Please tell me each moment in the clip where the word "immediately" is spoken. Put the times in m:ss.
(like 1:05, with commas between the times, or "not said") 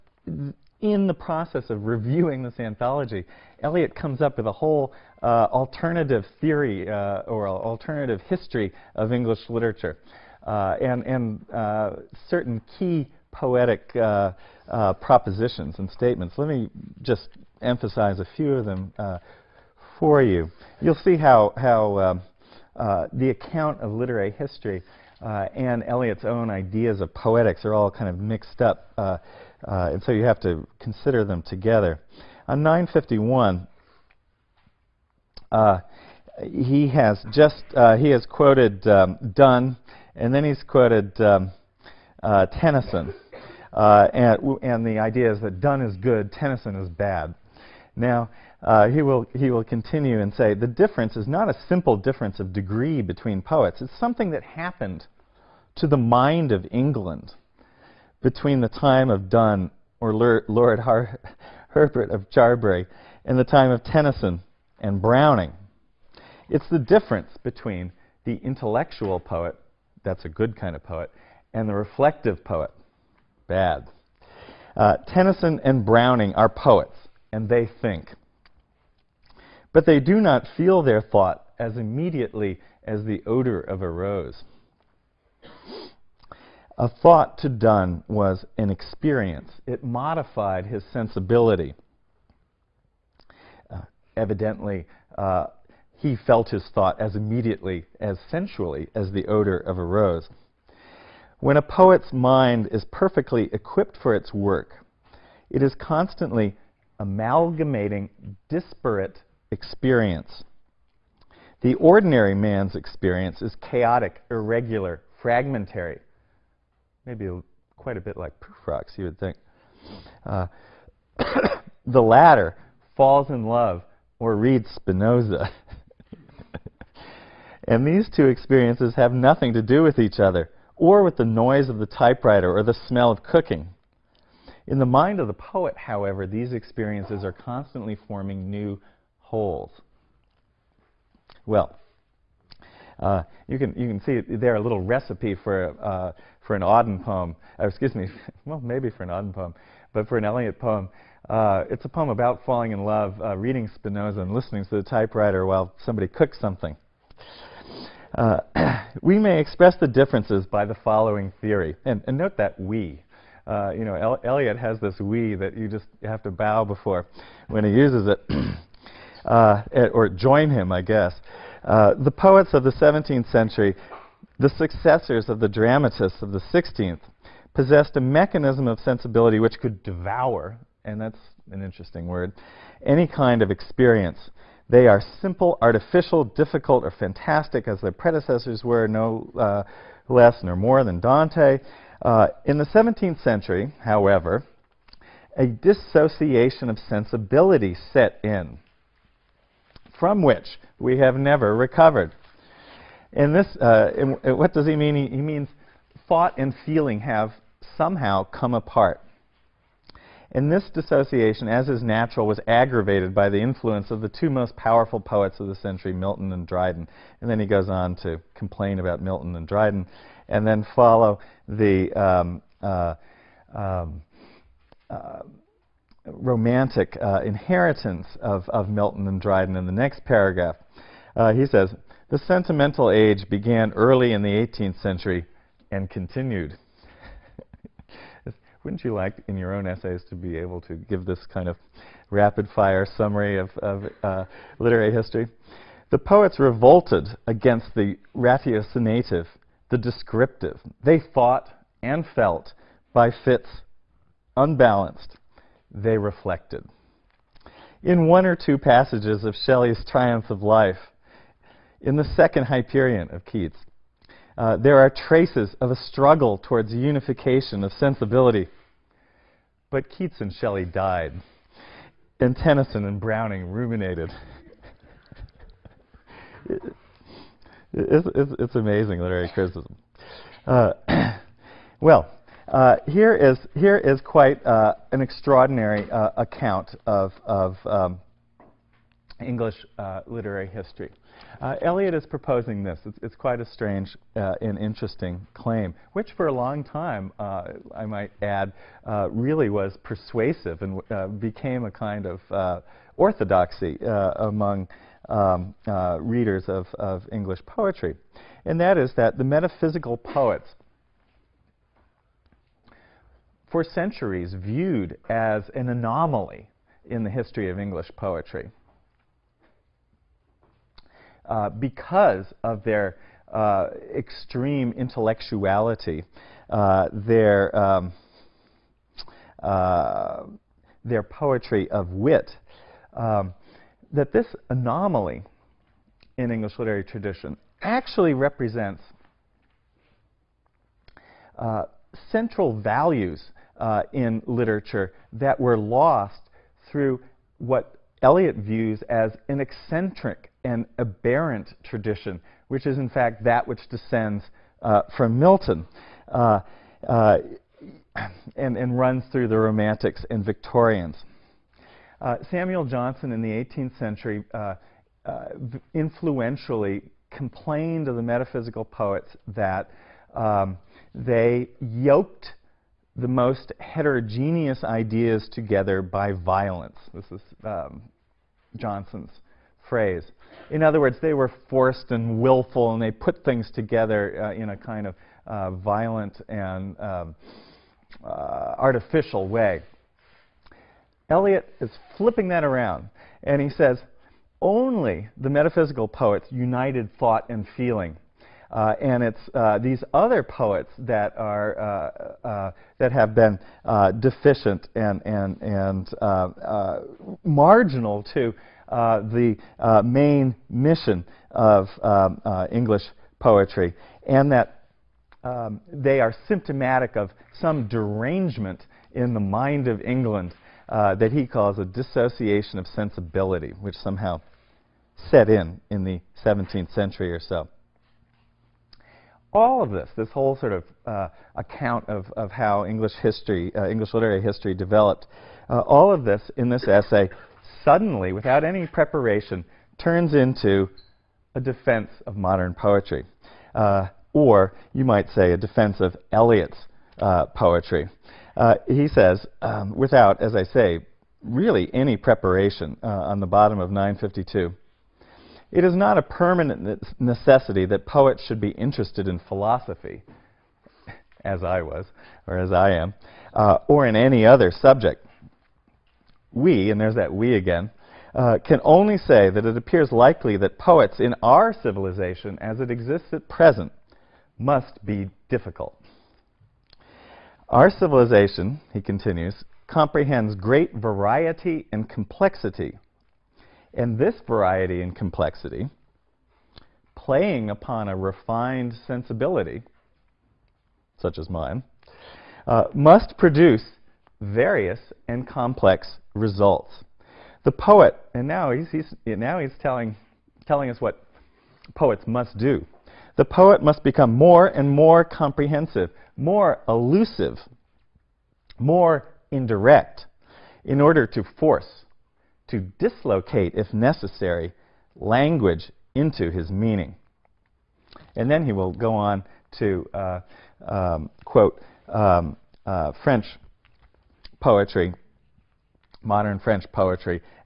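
1:21, 1:37.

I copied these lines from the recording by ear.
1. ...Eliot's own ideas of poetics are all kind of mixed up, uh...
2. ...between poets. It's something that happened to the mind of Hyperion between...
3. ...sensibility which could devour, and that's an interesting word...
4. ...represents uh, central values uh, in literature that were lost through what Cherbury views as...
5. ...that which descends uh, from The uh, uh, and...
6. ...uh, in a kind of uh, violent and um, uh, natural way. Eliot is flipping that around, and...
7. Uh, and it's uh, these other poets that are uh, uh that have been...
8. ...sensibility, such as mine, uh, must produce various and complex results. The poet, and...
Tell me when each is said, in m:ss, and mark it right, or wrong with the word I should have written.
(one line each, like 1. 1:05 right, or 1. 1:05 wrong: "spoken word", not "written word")
1. 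0:25 right
2. 0:53 wrong: "England", not "Hyperion"
3. 2:58 right
4. 5:38 wrong: "Eliot", not "Cherbury"
5. 5:53 wrong: "Milton", not "The"
6. 6:24 wrong: "artificial", not "natural"
7. 6:38 right
8. 8:08 right.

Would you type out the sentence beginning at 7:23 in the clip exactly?
Uh, or, you might say, a defense of Eliot's uh, poetry.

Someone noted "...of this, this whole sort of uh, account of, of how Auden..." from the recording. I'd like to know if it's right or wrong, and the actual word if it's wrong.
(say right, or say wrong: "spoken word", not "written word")
wrong: "English", not "Auden".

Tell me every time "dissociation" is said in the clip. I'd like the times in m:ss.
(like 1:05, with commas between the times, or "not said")
3:15, 3:30, 7:01.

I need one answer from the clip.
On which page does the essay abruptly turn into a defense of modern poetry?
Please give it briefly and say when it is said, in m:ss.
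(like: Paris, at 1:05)
952, at 7:33.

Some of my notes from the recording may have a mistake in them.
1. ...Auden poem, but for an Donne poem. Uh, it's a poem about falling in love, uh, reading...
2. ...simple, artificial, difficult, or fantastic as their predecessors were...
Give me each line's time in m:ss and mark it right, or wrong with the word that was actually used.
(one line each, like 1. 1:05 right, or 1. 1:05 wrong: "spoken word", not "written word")
1. 2:29 wrong: "Eliot", not "Donne"
2. 3:05 right.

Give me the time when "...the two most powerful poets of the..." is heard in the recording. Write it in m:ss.
3:34.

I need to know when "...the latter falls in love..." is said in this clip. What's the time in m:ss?
2:01.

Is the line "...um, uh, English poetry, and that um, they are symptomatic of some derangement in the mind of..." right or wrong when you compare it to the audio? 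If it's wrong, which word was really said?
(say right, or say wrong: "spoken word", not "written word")
right.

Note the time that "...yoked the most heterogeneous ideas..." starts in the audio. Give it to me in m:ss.
6:11.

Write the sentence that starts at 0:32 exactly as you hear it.
On 951, he has just he has quoted um, Donne and then he's quoted um, uh, Tennyson.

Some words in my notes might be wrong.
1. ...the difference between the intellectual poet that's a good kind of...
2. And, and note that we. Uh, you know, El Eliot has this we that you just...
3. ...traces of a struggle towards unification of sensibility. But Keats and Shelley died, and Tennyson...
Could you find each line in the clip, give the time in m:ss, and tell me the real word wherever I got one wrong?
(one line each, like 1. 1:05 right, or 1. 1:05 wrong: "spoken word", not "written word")
1. 1:06 right
2. 2:41 right
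3. 4:24 right.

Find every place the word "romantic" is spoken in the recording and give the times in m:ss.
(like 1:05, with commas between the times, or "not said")
3:46, 5:59.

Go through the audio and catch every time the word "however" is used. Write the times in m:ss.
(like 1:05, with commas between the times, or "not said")
2:15, 3:13.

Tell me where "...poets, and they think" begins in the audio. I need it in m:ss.
1:16.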